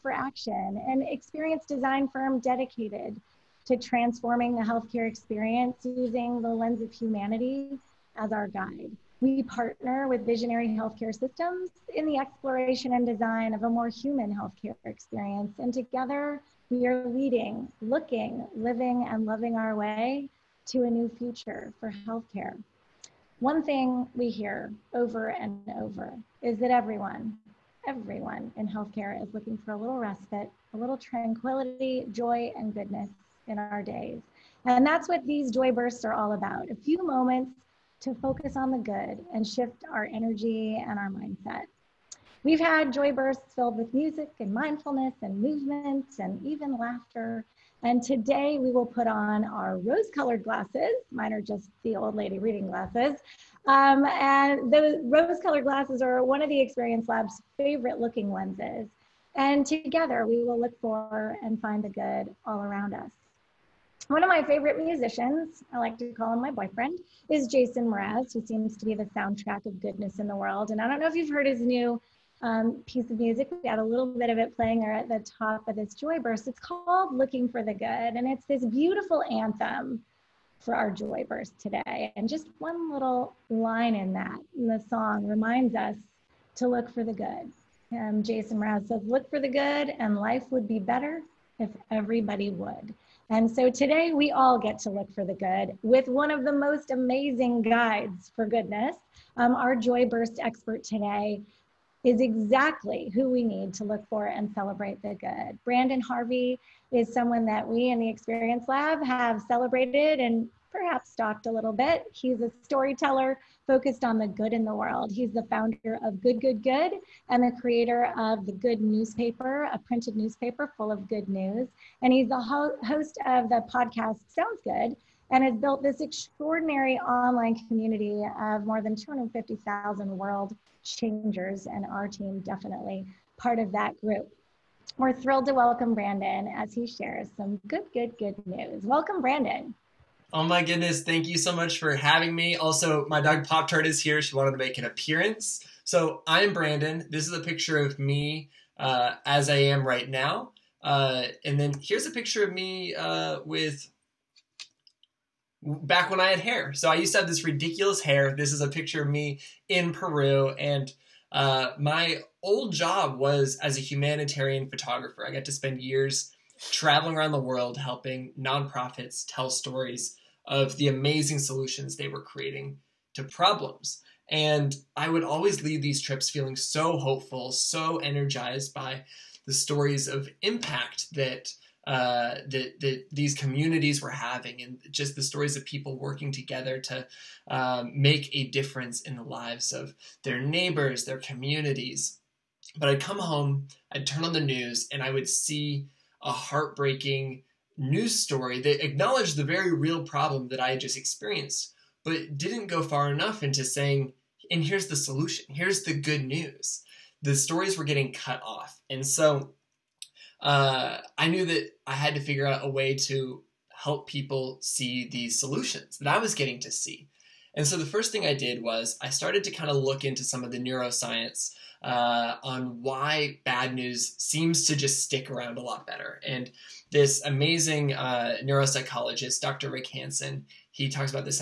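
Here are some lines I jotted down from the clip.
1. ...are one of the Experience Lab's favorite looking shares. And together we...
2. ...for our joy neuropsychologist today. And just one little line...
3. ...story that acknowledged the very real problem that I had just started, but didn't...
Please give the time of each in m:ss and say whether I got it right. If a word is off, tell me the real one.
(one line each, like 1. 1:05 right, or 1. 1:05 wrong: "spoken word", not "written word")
1. 0:56 wrong: "lenses", not "shares"
2. 1:20 wrong: "burst", not "neuropsychologist"
3. 3:18 wrong: "experienced", not "started".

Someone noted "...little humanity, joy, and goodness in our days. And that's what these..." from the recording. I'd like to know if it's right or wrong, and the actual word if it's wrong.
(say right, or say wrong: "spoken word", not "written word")
wrong: "tranquility", not "humanity".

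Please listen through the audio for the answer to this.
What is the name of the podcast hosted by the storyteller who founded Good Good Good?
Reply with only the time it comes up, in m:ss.
2:04.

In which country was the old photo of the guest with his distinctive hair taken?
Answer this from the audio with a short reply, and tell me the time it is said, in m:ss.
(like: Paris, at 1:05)
Peru, at 2:39.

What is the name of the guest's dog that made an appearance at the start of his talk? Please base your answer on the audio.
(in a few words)
Pop Tart.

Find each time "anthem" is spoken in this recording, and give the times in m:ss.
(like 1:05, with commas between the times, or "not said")
1:19.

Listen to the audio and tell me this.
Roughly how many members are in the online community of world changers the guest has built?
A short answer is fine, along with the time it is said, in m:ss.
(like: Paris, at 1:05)
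250,000, at 2:08.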